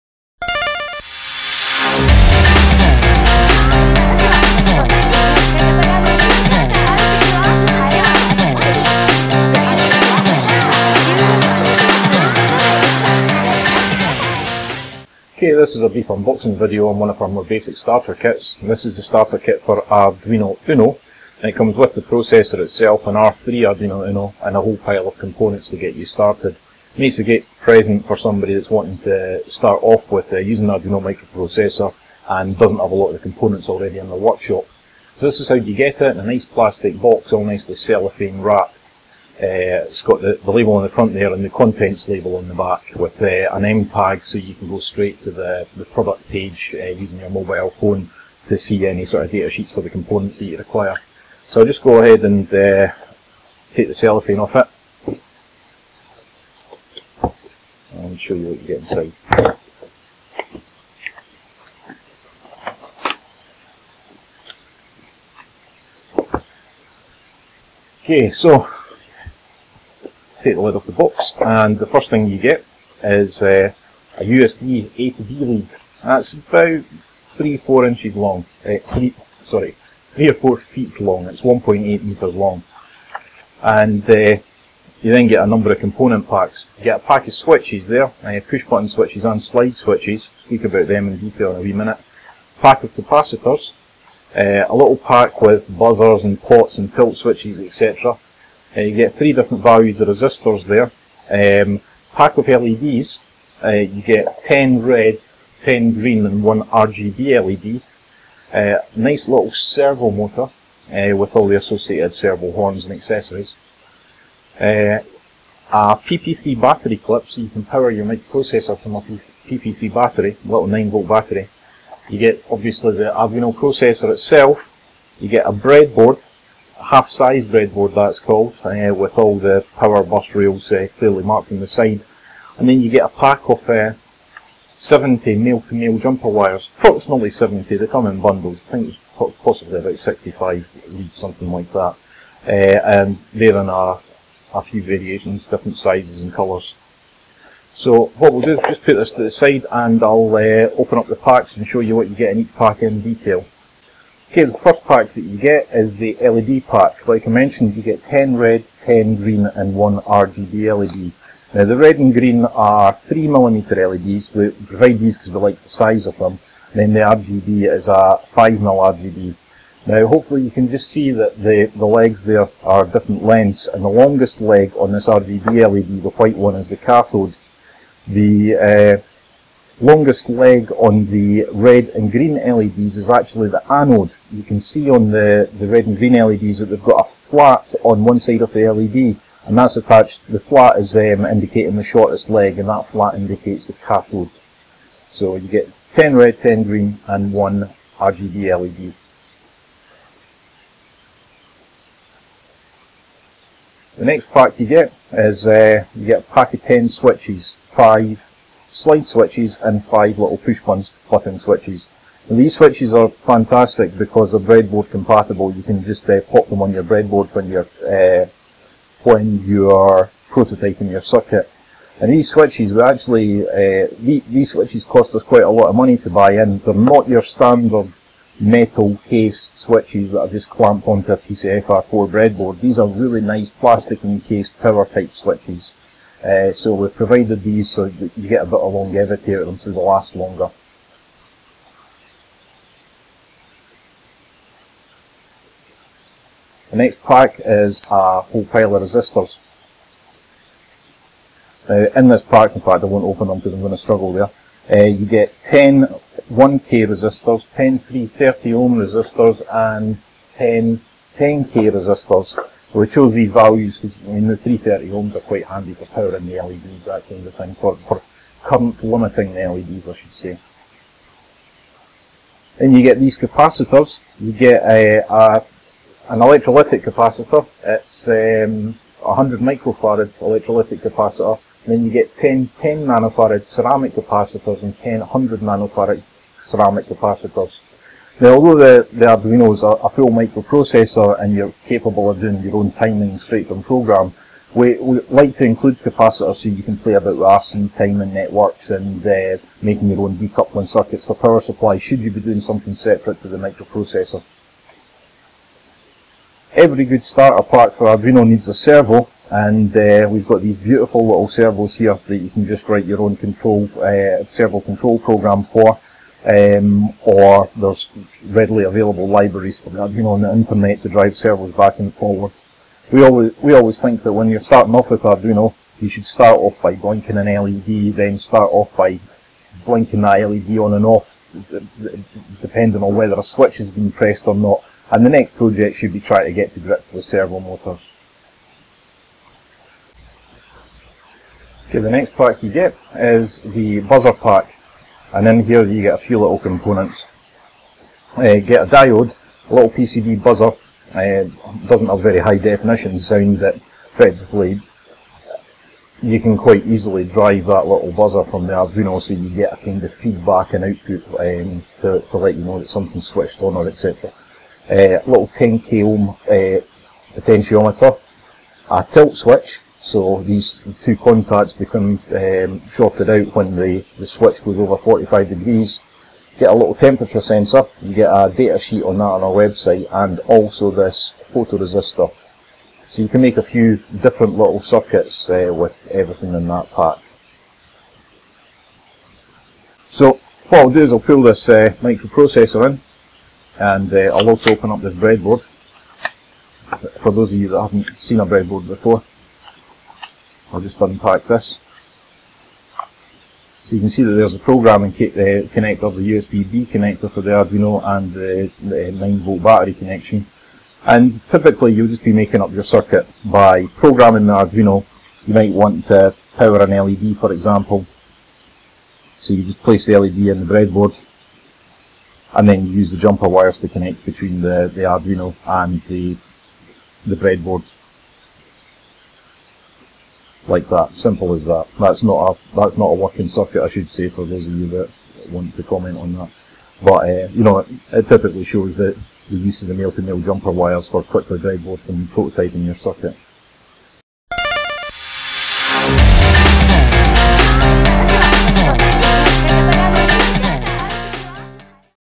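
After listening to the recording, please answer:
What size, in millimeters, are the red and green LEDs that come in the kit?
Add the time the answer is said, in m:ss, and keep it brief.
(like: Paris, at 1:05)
3mm, at 2:42.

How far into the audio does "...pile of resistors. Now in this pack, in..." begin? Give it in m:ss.
4:08.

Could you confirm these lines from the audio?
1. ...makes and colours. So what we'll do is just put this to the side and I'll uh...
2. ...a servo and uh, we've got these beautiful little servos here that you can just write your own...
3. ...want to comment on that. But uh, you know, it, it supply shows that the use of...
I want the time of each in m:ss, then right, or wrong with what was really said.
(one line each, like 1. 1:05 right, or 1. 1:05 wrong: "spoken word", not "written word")
1. 2:25 wrong: "sizes", not "makes"
2. 5:08 right
3. 7:15 wrong: "typically", not "supply".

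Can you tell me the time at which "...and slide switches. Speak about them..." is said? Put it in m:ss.
1:29.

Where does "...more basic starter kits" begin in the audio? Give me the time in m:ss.
0:17.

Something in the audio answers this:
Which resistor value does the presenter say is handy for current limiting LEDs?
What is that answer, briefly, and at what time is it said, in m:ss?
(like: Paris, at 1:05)
330 ohms, at 4:24.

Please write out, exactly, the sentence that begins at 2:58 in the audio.
The uh, longest leg on the red and green LEDs is actually the anode.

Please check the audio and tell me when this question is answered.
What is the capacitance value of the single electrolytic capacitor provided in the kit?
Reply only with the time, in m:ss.
4:39.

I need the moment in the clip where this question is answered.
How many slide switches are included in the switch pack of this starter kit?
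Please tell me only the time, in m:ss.
3:27.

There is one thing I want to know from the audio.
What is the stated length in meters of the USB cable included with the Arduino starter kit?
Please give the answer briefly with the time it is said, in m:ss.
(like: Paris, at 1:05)
1.8 meters, at 1:21.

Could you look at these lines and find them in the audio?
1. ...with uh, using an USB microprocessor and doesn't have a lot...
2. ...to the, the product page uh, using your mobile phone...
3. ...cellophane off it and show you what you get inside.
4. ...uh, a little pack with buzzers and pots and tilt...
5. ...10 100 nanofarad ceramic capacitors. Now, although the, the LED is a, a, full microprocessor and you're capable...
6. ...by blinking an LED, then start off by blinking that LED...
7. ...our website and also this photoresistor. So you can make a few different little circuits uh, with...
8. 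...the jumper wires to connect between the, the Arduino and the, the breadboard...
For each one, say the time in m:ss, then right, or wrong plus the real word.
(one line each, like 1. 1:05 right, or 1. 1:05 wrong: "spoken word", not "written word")
1. 0:30 wrong: "Arduino", not "USB"
2. 0:45 right
3. 0:53 right
4. 1:34 right
5. 4:44 wrong: "Arduino", not "LED"
6. 5:26 right
7. 6:19 right
8. 7:02 right.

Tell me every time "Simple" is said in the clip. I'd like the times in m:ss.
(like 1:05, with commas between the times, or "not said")
7:10.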